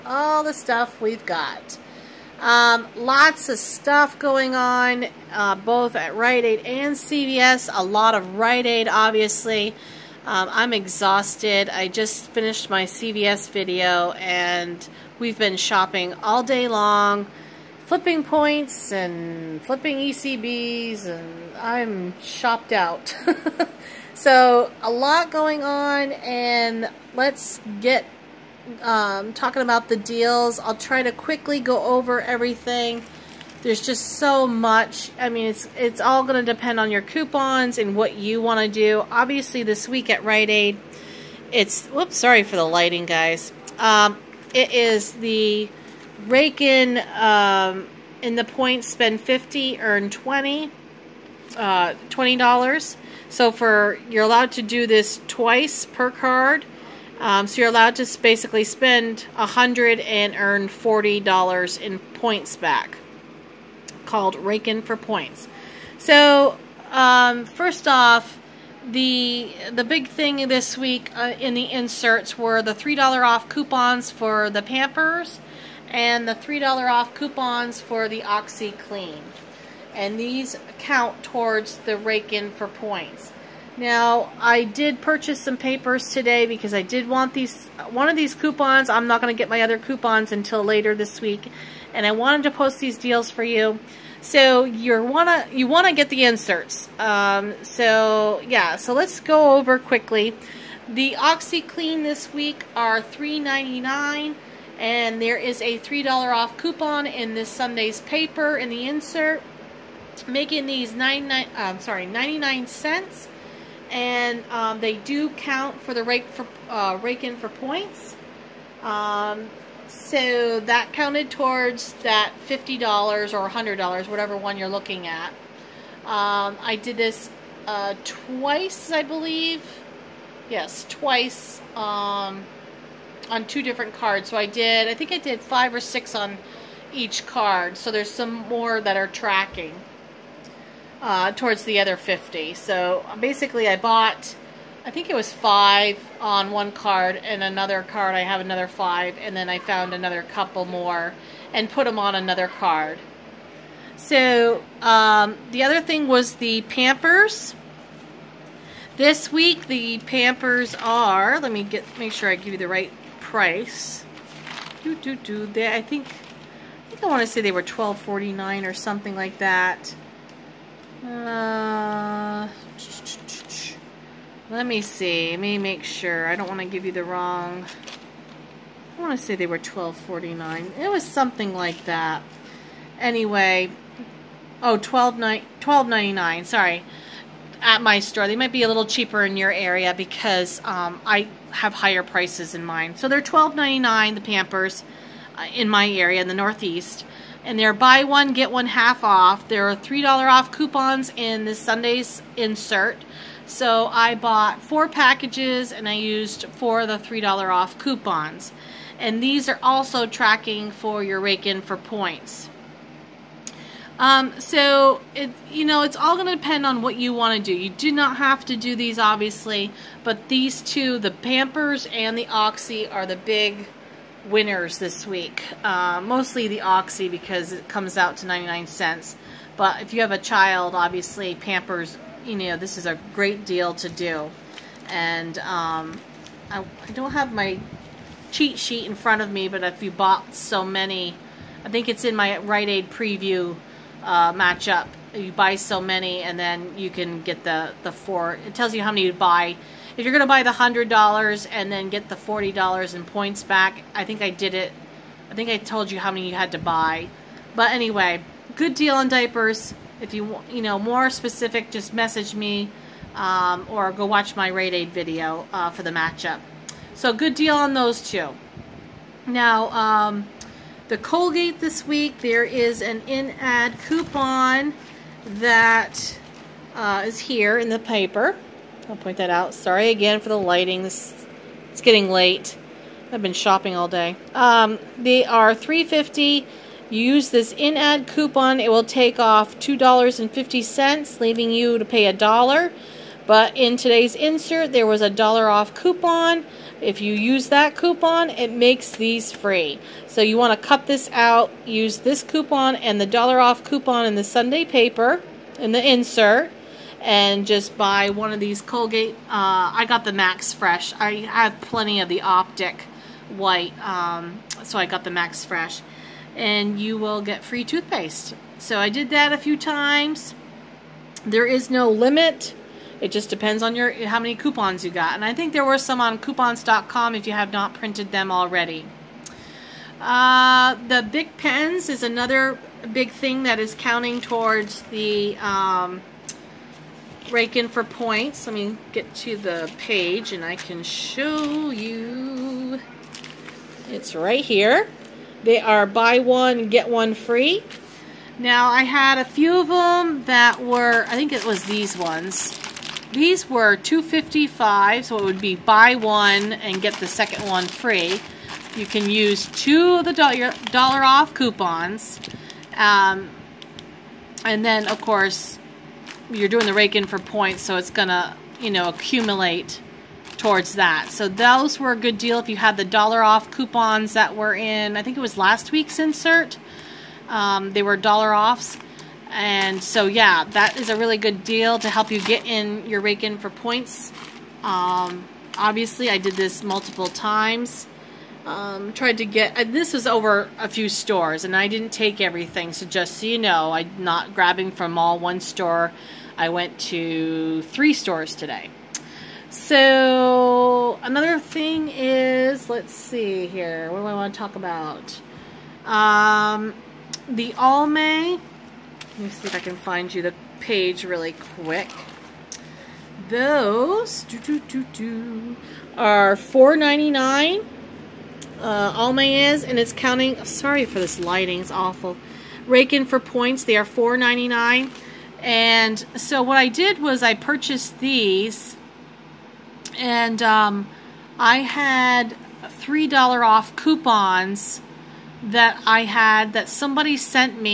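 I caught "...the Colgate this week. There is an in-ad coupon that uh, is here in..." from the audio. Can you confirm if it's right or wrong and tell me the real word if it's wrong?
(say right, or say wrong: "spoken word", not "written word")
right.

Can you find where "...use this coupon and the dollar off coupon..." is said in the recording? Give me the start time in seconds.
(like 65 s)
301 s.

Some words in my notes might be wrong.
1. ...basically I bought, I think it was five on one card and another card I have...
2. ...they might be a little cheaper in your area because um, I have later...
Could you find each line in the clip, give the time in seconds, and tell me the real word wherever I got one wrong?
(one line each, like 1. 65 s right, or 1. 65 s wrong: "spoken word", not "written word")
1. 143 s right
2. 188 s wrong: "higher", not "later".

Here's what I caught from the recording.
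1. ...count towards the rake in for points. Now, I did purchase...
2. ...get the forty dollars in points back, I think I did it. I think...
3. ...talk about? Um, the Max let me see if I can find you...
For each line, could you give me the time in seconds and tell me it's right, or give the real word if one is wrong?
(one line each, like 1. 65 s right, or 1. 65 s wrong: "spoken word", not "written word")
1. 80 s right
2. 251 s right
3. 404 s wrong: "Almay", not "Max".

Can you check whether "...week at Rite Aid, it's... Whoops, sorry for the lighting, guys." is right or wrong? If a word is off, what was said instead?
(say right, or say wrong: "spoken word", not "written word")
right.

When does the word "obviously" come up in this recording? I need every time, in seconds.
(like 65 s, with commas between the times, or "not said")
8 s, 39 s, 218 s, 230 s, 385 s.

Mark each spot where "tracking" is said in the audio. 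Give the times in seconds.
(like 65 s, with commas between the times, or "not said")
139 s, 210 s.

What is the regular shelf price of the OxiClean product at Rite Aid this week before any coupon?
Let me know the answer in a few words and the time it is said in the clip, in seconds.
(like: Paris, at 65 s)
$3.99, at 103 s.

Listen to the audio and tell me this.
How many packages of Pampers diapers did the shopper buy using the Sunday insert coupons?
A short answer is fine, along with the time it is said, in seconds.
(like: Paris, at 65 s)
4, at 204 s.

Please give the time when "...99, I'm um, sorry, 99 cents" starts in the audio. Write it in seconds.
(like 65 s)
110 s.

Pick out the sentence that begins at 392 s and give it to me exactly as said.
So just so you know, I'm not grabbing from all one store.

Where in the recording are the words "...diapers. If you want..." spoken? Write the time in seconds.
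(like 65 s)
259 s.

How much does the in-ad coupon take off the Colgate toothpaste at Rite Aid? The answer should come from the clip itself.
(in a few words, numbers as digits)
$2.50.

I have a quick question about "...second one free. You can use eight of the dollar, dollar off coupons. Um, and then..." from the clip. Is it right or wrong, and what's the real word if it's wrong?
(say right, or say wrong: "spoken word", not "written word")
wrong: "two", not "eight".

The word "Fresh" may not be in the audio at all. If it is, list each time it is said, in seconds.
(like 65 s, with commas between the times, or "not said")
310 s, 315 s.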